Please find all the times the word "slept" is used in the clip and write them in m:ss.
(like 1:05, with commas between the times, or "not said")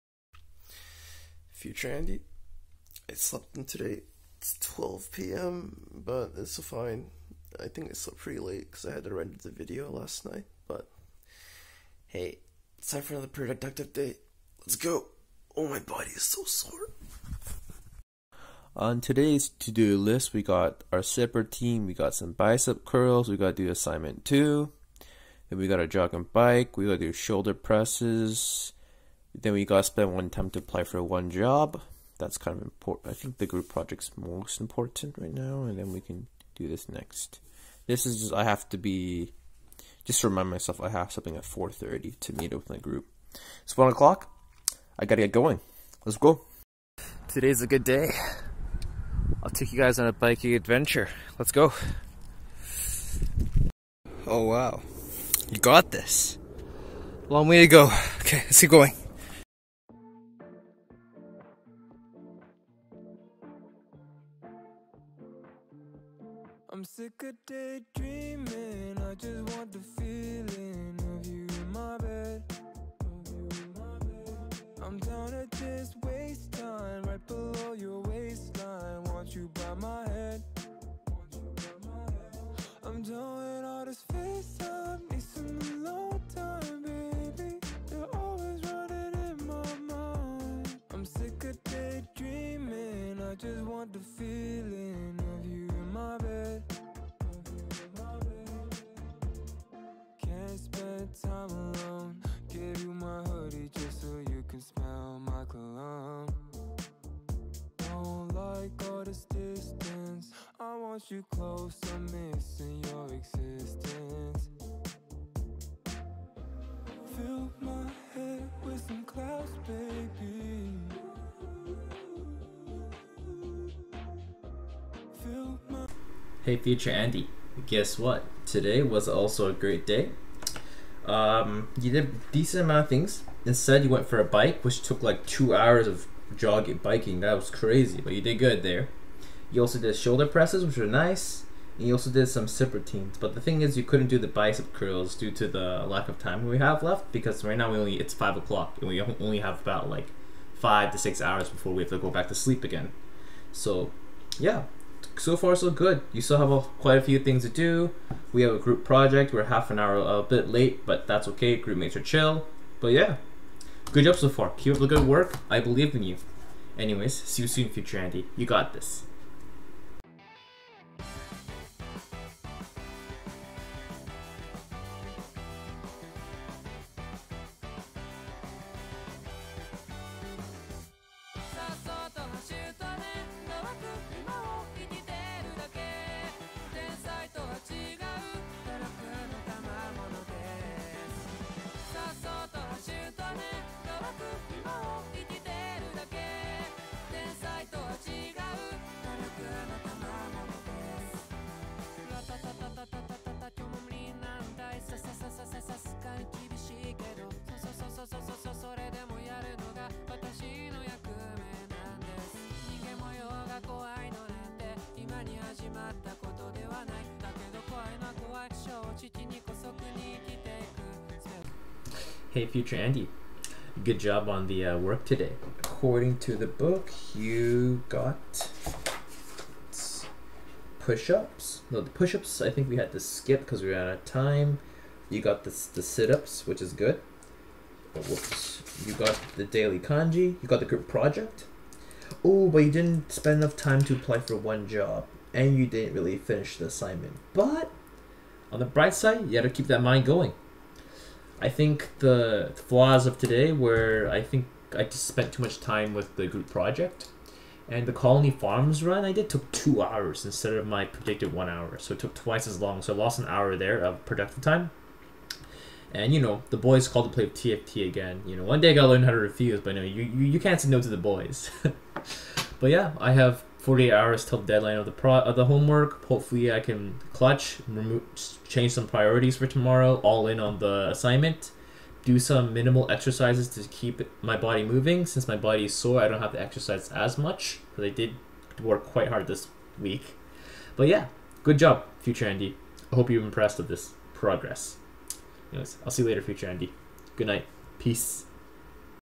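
0:03, 0:07.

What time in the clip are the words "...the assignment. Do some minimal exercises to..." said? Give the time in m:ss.
4:40.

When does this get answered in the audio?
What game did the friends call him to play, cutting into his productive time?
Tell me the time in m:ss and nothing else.
4:27.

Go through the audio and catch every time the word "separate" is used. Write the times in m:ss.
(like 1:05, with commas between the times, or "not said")
0:21.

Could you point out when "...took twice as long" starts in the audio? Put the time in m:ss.
4:21.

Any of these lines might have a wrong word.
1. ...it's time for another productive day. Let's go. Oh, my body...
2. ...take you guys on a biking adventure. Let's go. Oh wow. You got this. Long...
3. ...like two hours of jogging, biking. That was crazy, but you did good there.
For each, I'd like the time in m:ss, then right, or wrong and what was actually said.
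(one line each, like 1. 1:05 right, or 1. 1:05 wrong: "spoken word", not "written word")
1. 0:12 right
2. 0:49 right
3. 2:15 right.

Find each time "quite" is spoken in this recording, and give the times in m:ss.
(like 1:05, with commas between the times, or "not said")
2:36, 4:48.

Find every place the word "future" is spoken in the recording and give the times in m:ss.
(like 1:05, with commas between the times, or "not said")
0:01, 2:06, 2:47, 3:42, 4:52, 4:56.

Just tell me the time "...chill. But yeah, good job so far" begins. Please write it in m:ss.
2:42.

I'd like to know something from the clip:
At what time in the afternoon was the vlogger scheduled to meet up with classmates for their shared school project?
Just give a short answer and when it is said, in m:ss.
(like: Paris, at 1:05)
4:30, at 0:41.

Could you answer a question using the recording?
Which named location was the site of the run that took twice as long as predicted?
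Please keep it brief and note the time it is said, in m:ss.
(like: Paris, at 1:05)
Colony Farms, at 4:17.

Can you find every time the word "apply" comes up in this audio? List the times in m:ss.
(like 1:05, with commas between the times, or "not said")
0:30, 4:03.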